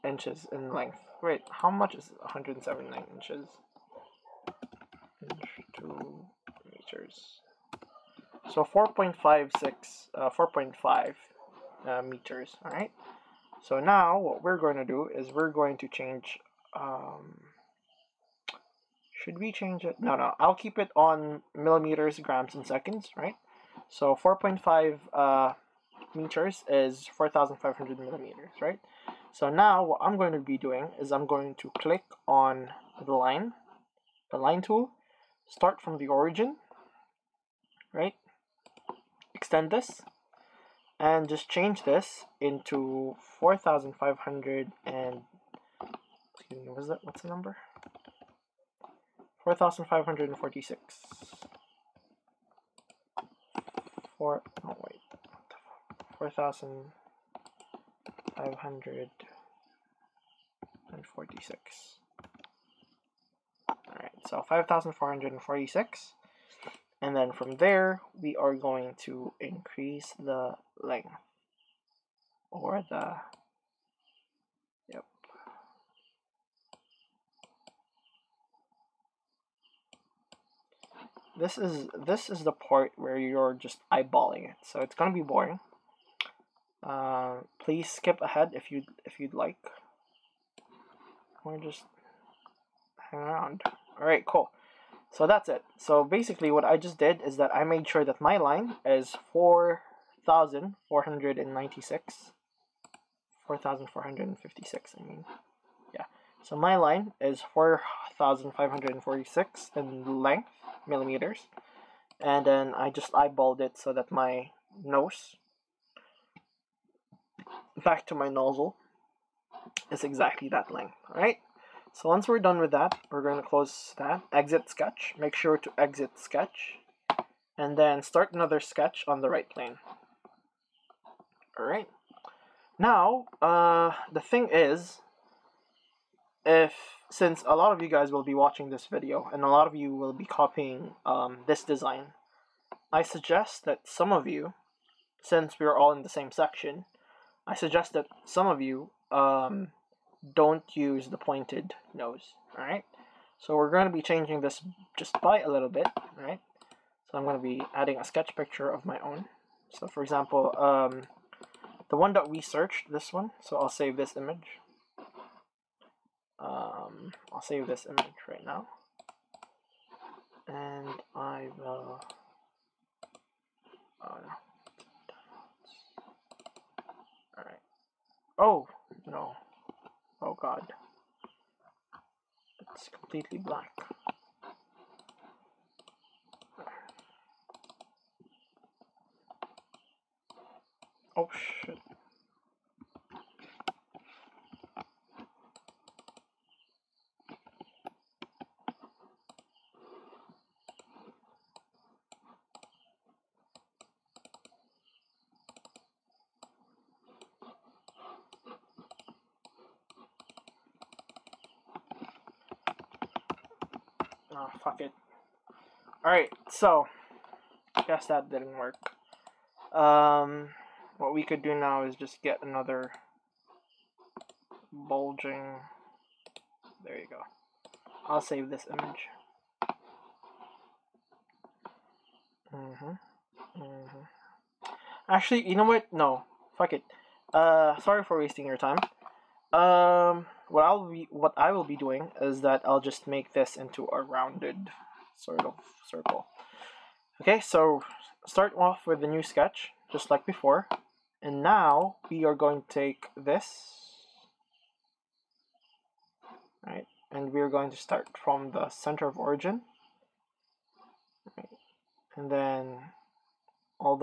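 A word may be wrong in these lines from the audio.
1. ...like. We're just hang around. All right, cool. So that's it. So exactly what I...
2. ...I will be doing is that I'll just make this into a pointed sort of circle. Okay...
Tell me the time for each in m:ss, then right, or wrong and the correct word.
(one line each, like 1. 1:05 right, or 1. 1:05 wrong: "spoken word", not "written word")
1. 1:29 wrong: "basically", not "exactly"
2. 4:01 wrong: "rounded", not "pointed".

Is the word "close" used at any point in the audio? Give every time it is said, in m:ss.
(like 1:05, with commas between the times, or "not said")
2:03.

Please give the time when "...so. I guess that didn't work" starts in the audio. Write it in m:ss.
3:36.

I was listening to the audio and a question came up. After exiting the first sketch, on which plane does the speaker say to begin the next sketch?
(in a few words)
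right plane.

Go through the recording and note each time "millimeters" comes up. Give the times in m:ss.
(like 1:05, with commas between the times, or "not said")
0:21, 0:27, 1:50.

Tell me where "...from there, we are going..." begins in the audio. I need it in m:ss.
1:07.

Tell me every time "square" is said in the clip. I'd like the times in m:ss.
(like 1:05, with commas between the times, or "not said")
not said.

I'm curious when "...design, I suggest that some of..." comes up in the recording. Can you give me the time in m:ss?
2:21.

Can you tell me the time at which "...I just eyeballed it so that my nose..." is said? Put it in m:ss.
1:52.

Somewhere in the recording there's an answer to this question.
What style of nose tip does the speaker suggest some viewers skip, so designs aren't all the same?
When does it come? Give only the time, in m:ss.
2:31.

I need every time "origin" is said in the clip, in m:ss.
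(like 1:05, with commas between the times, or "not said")
0:36, 4:19.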